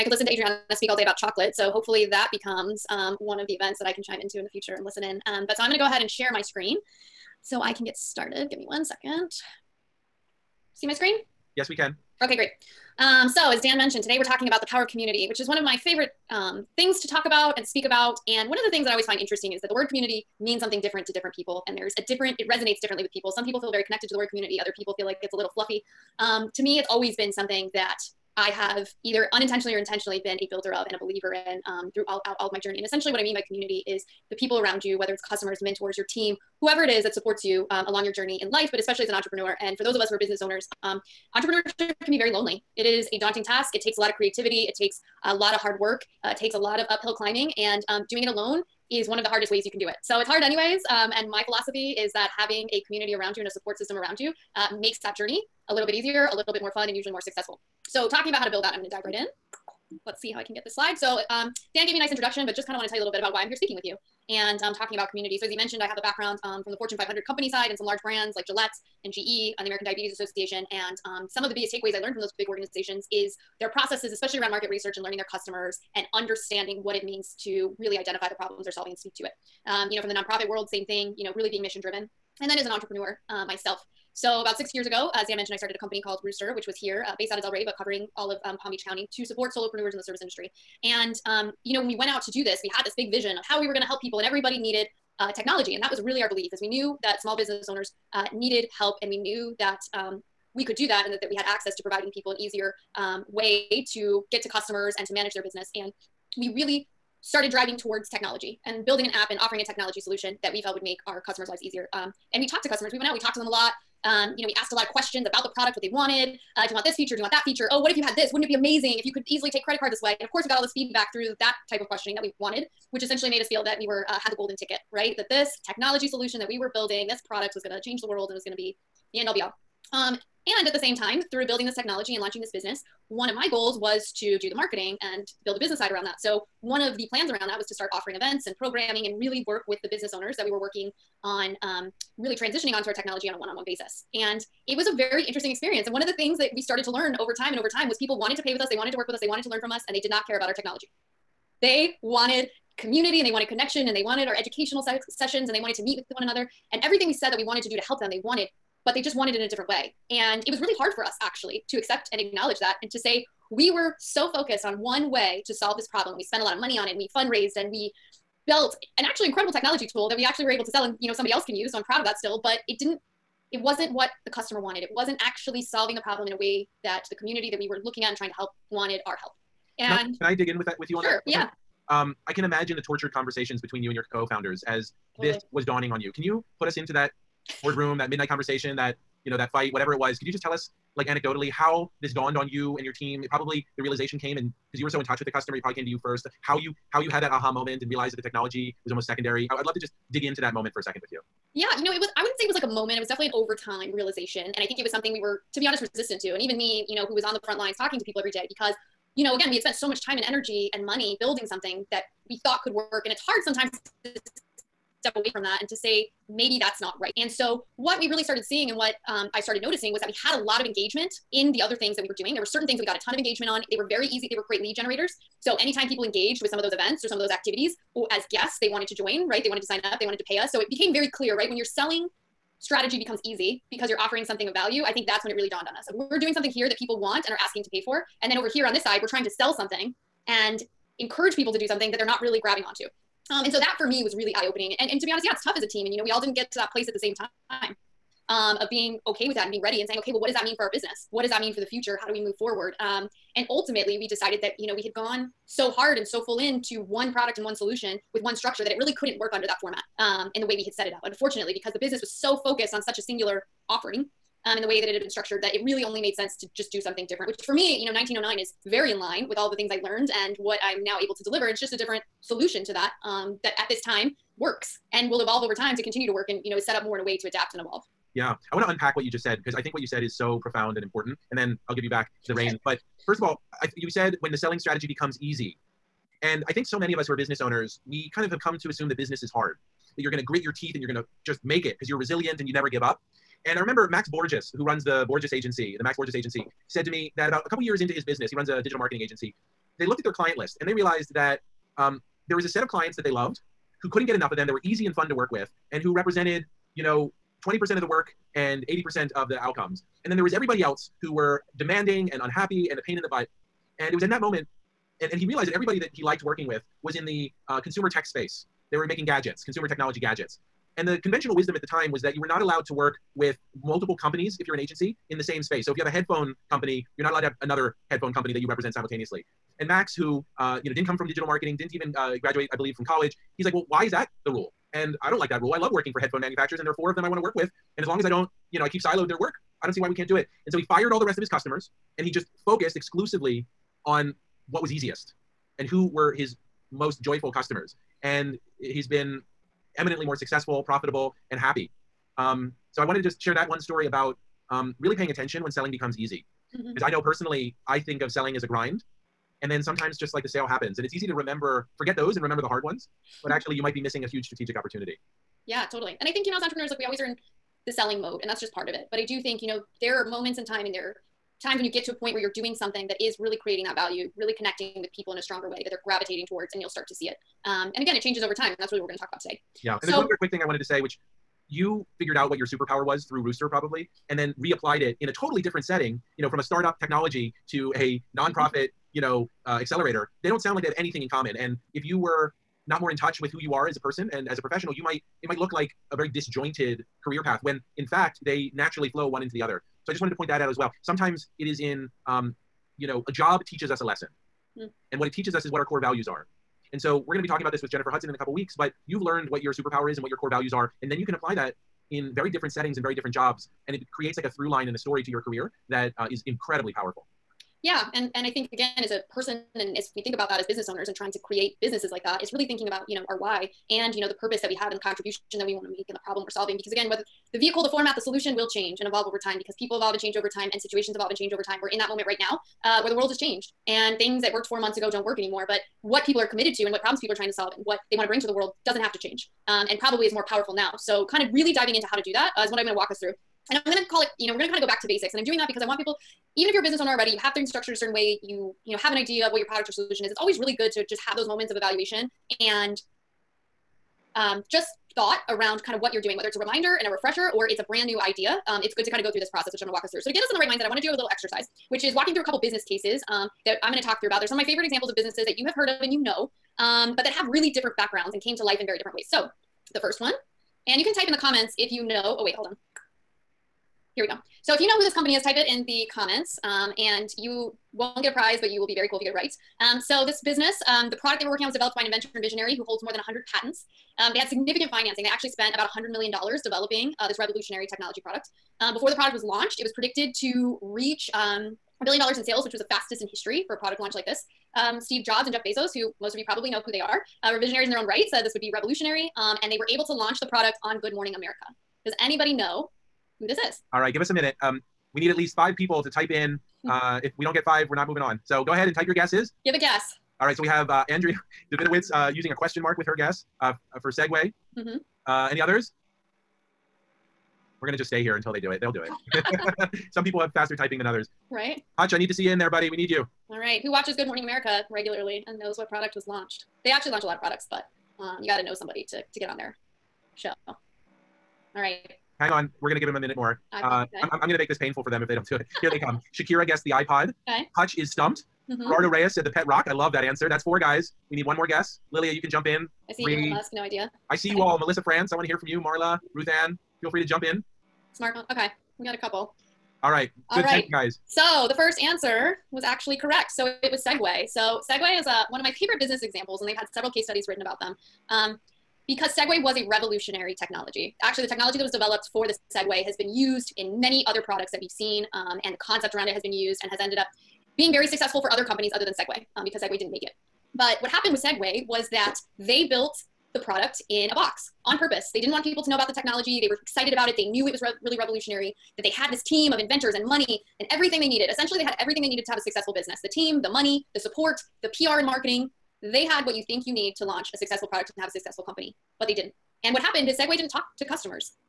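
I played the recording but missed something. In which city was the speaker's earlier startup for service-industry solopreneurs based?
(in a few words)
Delray.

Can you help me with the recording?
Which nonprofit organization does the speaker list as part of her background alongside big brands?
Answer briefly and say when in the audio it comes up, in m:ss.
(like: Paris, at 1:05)
American Diabetes Association, at 1:09.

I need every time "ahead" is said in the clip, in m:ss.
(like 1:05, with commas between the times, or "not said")
0:05, 8:28.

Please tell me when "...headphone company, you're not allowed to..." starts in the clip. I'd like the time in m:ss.
5:25.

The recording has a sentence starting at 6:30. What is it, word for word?
They don't sound like they have anything in common.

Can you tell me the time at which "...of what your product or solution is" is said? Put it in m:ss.
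7:29.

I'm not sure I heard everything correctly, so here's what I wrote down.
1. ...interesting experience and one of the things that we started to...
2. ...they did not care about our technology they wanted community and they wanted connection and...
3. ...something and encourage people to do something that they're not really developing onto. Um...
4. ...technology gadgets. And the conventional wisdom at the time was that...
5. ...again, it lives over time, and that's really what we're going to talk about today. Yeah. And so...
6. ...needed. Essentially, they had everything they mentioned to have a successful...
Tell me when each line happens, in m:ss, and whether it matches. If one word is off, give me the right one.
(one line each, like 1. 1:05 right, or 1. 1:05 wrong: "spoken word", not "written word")
1. 2:25 right
2. 2:29 right
3. 3:59 wrong: "grabbing", not "developing"
4. 5:19 right
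5. 6:17 wrong: "changes", not "lives"
6. 9:41 wrong: "needed", not "mentioned".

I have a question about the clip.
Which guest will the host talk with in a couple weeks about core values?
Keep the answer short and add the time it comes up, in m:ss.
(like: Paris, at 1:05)
Jennifer Hudson, at 6:47.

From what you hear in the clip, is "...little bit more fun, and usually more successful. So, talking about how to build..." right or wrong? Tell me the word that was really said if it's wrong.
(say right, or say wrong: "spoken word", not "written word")
right.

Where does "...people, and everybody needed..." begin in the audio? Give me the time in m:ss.
1:34.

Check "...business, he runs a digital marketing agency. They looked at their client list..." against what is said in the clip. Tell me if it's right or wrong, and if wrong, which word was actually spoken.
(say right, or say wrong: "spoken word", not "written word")
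right.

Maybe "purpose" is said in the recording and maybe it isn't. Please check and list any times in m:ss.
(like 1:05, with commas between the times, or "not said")
7:04, 9:34.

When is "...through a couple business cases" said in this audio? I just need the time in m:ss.
7:42.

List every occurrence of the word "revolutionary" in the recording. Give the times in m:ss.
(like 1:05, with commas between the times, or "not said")
8:07, 8:18, 9:19, 9:37.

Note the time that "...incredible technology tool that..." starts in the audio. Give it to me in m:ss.
2:49.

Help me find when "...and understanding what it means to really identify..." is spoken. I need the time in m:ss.
1:15.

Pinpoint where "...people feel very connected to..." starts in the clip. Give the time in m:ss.
0:23.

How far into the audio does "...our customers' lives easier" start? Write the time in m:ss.
1:51.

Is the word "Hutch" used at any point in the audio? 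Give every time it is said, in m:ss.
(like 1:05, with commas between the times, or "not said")
8:41, 8:57.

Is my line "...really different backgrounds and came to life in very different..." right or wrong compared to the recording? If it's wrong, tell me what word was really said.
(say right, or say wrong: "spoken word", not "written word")
right.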